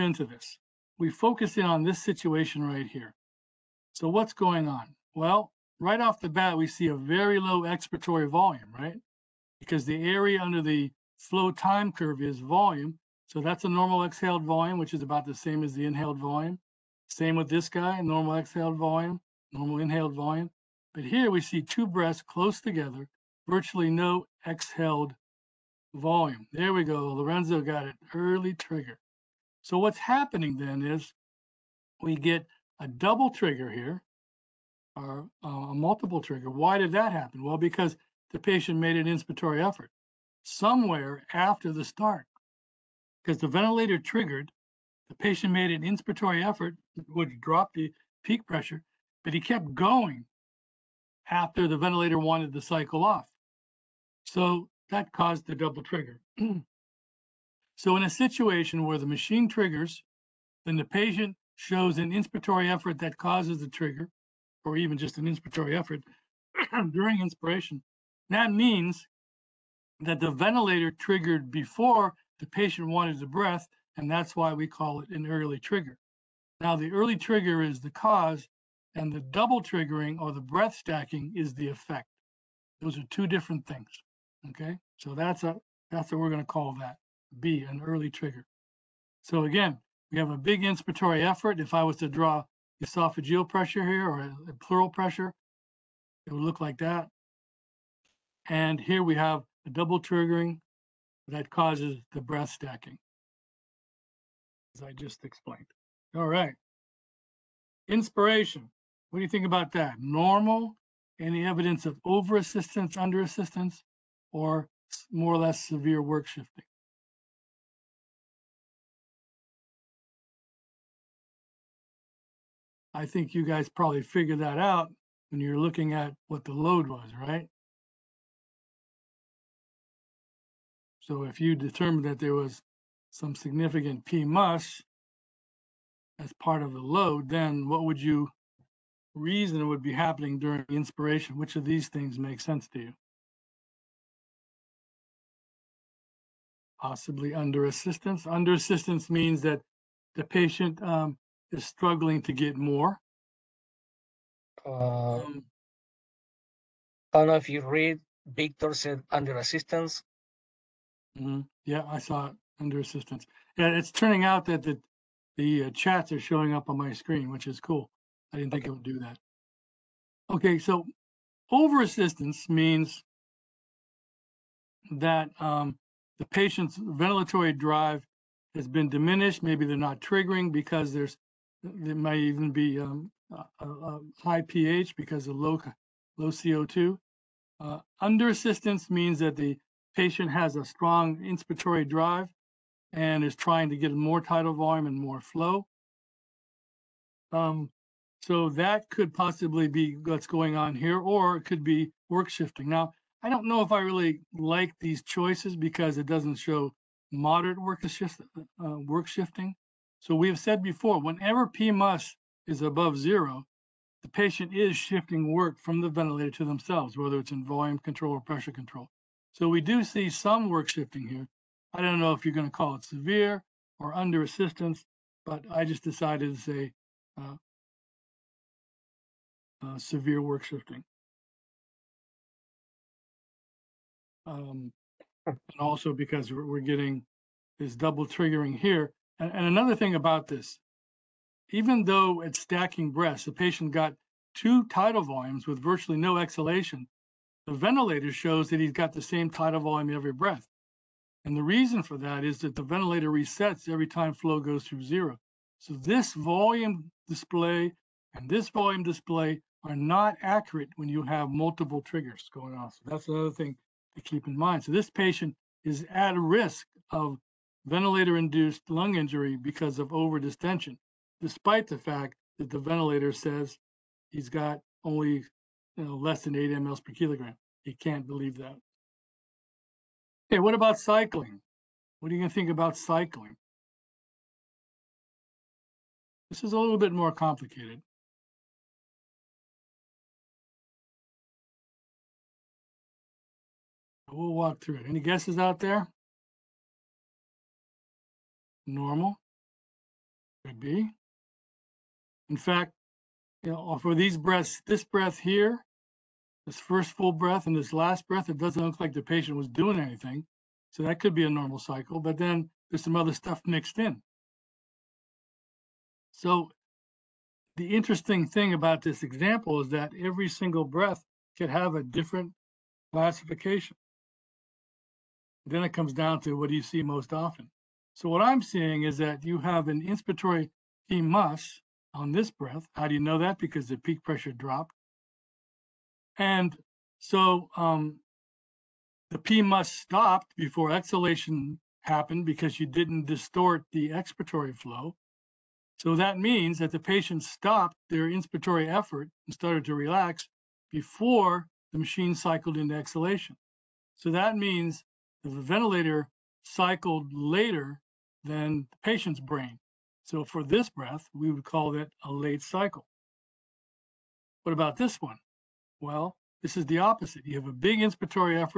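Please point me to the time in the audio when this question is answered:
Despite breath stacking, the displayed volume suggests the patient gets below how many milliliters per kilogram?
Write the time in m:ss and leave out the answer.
4:36.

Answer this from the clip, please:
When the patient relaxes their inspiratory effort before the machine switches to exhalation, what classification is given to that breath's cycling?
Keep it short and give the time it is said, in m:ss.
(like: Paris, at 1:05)
Late cycle, at 6:02.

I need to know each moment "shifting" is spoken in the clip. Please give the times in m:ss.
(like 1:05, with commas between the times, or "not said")
1:56, 3:22, 3:29, 3:34, 3:40, 3:50.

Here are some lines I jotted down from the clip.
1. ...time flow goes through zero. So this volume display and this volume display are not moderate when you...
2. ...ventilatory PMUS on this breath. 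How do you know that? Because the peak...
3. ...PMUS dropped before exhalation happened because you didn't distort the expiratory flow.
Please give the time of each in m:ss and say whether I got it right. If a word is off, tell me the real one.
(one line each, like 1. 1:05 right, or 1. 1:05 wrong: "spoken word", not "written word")
1. 4:13 wrong: "accurate", not "moderate"
2. 5:29 wrong: "inspiratory", not "ventilatory"
3. 5:39 wrong: "stopped", not "dropped".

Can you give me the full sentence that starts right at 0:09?
Because the area under the flow time curve is volume.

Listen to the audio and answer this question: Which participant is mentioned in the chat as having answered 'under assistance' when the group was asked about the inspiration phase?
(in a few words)
Victor.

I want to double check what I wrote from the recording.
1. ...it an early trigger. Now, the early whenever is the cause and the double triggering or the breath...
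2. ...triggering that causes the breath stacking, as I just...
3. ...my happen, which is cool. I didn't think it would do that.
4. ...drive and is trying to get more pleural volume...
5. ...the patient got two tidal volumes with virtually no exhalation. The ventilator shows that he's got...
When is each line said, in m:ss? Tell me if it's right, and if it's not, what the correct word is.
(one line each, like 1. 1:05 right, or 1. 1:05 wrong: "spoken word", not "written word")
1. 1:15 wrong: "trigger", not "whenever"
2. 1:40 right
3. 2:46 wrong: "screen", not "happen"
4. 3:11 wrong: "tidal", not "pleural"
5. 4:03 right.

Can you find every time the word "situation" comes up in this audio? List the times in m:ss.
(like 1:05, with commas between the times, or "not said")
0:02, 0:58.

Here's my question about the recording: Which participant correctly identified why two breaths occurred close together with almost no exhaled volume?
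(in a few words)
Lorenzo.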